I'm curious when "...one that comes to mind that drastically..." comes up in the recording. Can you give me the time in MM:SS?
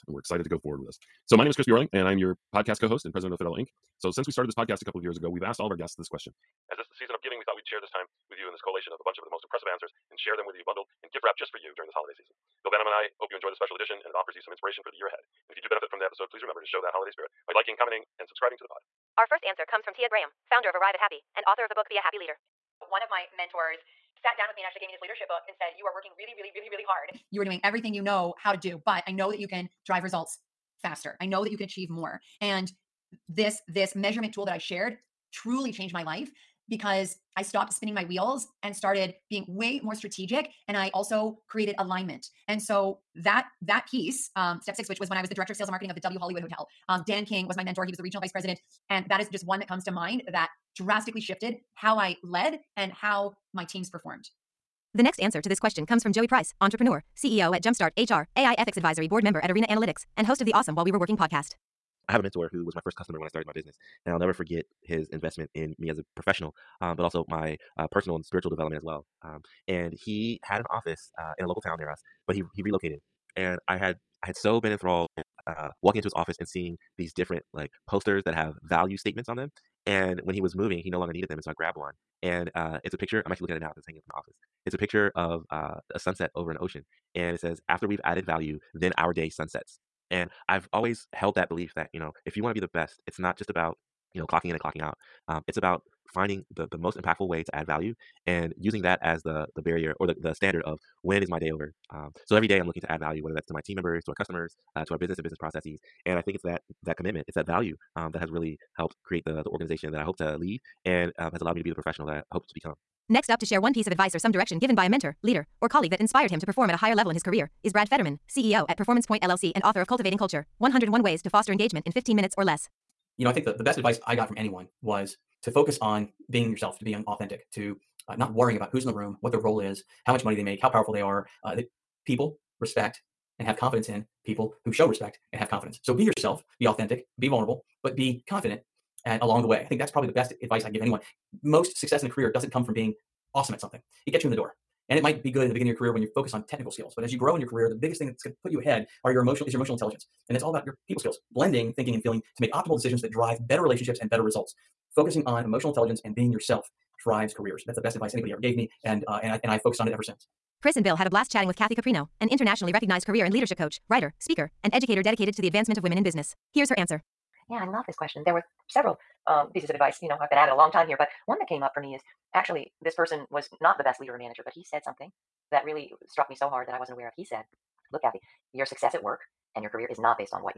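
00:49.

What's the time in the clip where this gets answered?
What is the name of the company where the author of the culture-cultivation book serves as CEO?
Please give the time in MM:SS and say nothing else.
01:58.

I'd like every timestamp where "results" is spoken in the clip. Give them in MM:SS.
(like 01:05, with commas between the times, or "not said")
00:30, 02:34.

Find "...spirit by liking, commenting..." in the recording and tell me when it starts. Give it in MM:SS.
00:17.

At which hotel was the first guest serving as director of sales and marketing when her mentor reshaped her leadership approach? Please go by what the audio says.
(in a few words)
W Hollywood Hotel.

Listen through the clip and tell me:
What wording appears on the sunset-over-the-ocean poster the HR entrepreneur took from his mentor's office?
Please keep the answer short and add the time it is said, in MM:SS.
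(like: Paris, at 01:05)
After we've added value, then our day sunsets, at 01:27.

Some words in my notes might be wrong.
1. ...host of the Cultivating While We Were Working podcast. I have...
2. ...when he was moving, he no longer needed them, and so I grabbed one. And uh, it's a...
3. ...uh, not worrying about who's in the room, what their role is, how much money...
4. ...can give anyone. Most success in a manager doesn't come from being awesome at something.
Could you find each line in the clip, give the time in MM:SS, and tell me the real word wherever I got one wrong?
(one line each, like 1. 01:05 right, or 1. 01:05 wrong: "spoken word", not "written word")
1. 01:00 wrong: "Awesome", not "Cultivating"
2. 01:20 right
3. 02:08 right
4. 02:20 wrong: "career", not "manager".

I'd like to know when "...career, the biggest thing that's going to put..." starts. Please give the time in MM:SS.
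02:27.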